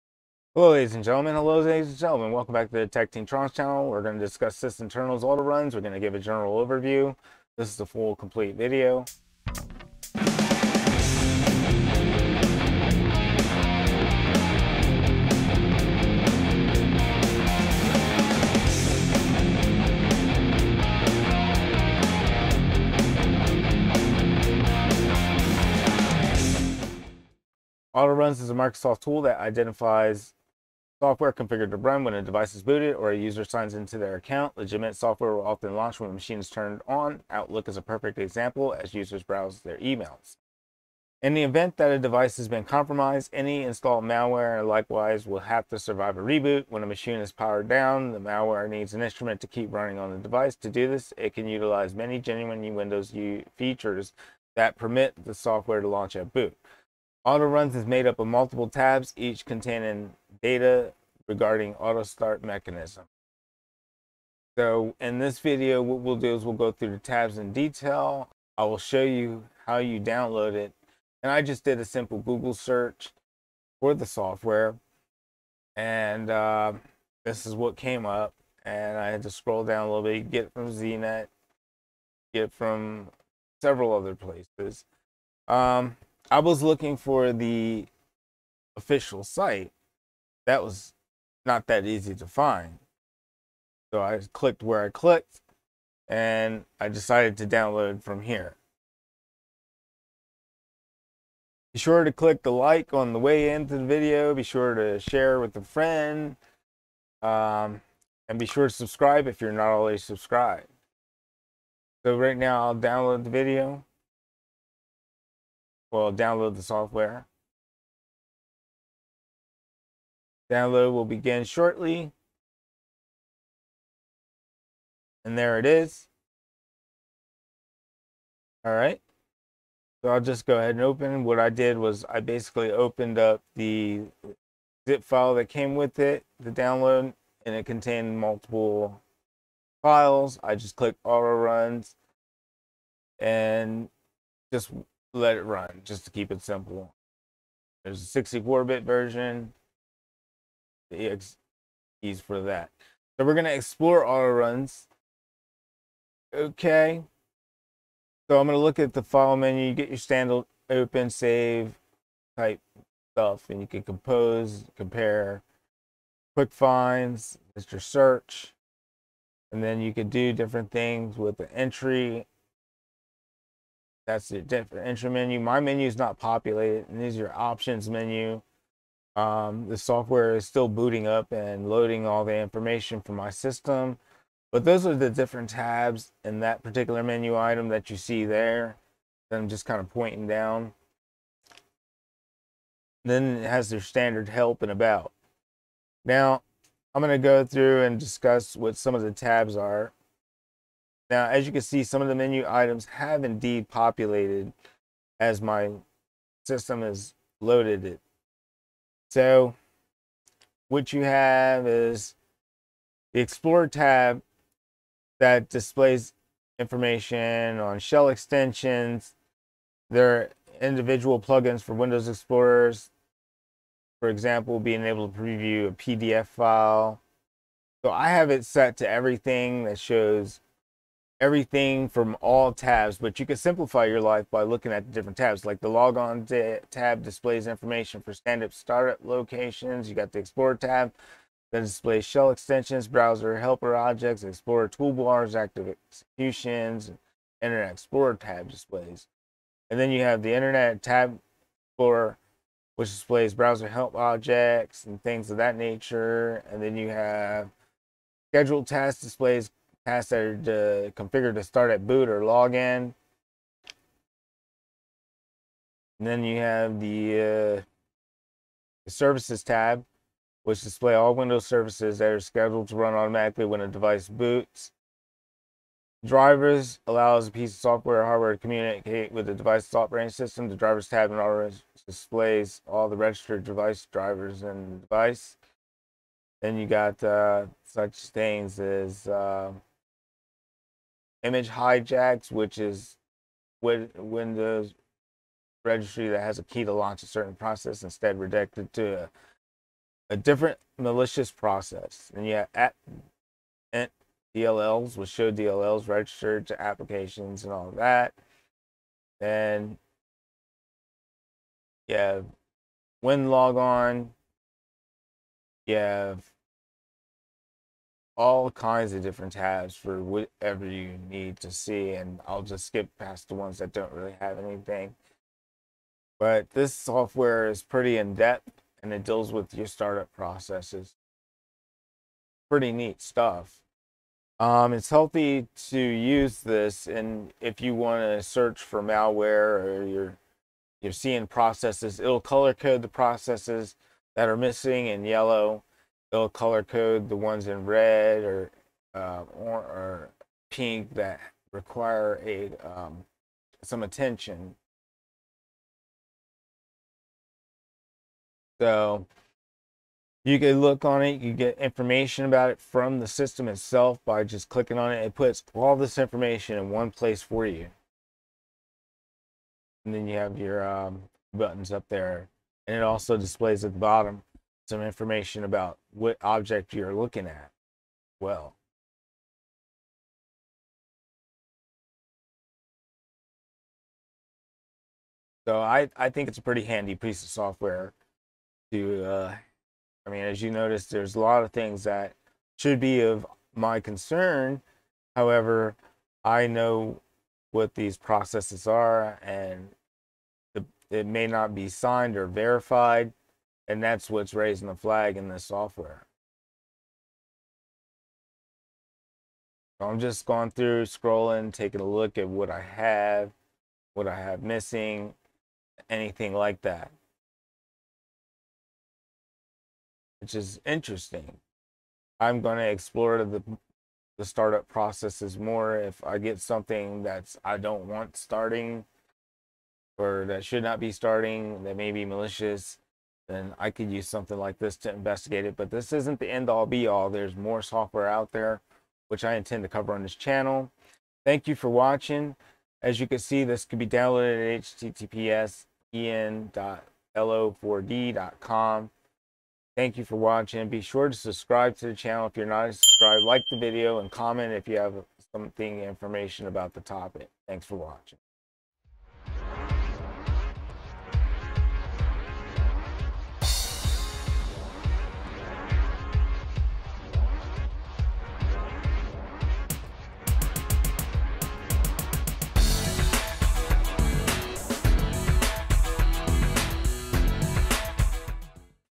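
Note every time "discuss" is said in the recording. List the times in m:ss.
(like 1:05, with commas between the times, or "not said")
0:04, 3:17.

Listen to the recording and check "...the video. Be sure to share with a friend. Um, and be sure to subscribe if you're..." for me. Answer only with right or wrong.
right.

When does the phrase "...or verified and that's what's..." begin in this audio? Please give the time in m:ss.
6:42.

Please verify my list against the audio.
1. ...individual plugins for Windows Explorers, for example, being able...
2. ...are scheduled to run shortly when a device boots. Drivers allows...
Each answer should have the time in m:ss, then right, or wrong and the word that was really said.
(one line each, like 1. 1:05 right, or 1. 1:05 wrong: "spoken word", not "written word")
1. 3:40 right
2. 4:32 wrong: "automatically", not "shortly".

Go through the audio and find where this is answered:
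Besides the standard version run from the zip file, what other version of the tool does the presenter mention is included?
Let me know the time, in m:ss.
2:28.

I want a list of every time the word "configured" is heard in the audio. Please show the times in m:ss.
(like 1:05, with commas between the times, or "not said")
0:31, 4:21.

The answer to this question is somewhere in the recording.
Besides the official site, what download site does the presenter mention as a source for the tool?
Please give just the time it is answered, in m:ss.
1:20.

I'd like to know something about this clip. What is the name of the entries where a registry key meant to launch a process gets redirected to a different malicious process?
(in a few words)
image hijacks.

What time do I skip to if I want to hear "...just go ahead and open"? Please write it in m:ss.
2:10.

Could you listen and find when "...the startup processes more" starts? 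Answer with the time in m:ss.
7:04.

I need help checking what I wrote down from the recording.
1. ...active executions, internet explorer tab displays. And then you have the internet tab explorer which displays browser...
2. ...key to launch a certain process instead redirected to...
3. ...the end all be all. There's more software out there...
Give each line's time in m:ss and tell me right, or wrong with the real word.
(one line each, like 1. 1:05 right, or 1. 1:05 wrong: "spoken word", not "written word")
1. 4:05 right
2. 4:56 right
3. 7:16 right.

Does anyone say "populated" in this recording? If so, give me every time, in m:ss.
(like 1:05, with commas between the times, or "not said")
2:56, 3:23.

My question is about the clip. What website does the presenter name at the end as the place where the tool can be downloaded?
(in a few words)
en.lo4d.com.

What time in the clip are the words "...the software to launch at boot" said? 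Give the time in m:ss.
0:55.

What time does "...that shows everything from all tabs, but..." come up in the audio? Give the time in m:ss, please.
3:49.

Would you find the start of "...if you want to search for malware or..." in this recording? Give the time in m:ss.
5:37.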